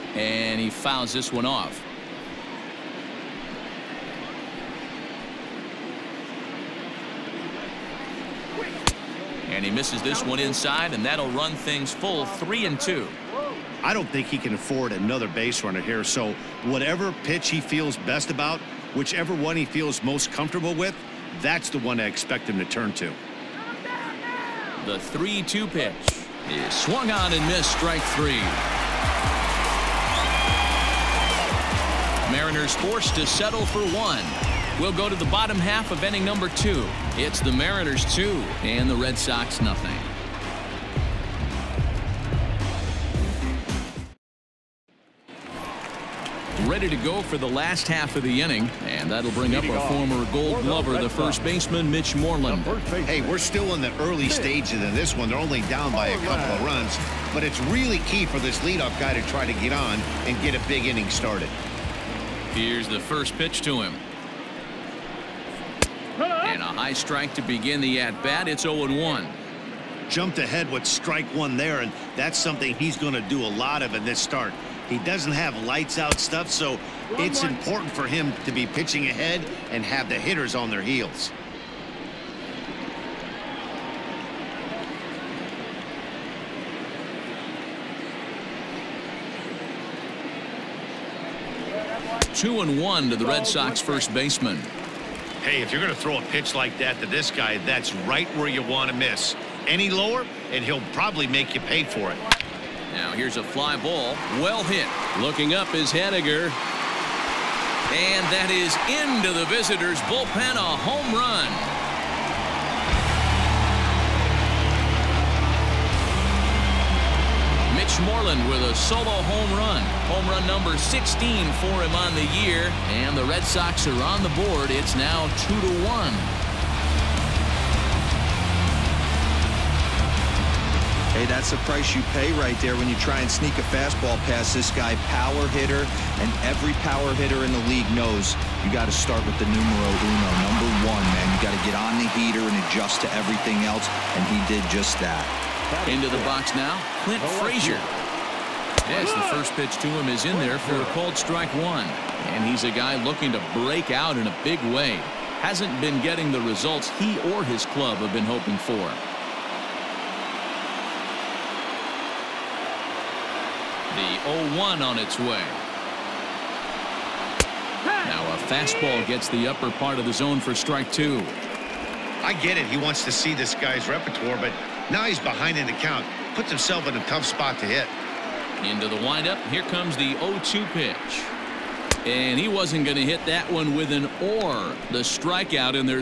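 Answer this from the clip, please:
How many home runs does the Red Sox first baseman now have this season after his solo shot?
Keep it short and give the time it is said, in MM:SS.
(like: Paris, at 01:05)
16, at 02:00.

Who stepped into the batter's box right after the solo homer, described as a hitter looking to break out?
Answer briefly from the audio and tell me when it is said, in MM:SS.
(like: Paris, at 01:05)
Clint Frazier, at 02:27.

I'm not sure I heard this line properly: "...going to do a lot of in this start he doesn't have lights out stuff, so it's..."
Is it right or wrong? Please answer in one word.
right.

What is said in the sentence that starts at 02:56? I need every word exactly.
Puts himself in a tough spot to hit.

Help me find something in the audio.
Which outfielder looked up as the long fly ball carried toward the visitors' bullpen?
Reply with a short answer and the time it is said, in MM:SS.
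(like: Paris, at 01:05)
Haniger, at 01:45.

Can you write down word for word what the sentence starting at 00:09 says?
And he misses this one inside, and that'll run things full three and two.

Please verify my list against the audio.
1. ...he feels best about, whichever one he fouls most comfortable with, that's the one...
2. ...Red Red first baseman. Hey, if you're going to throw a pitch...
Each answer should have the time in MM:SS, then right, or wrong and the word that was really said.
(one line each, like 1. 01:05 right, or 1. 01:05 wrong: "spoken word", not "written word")
1. 00:17 wrong: "feels", not "fouls"
2. 01:33 wrong: "Sox", not "Red".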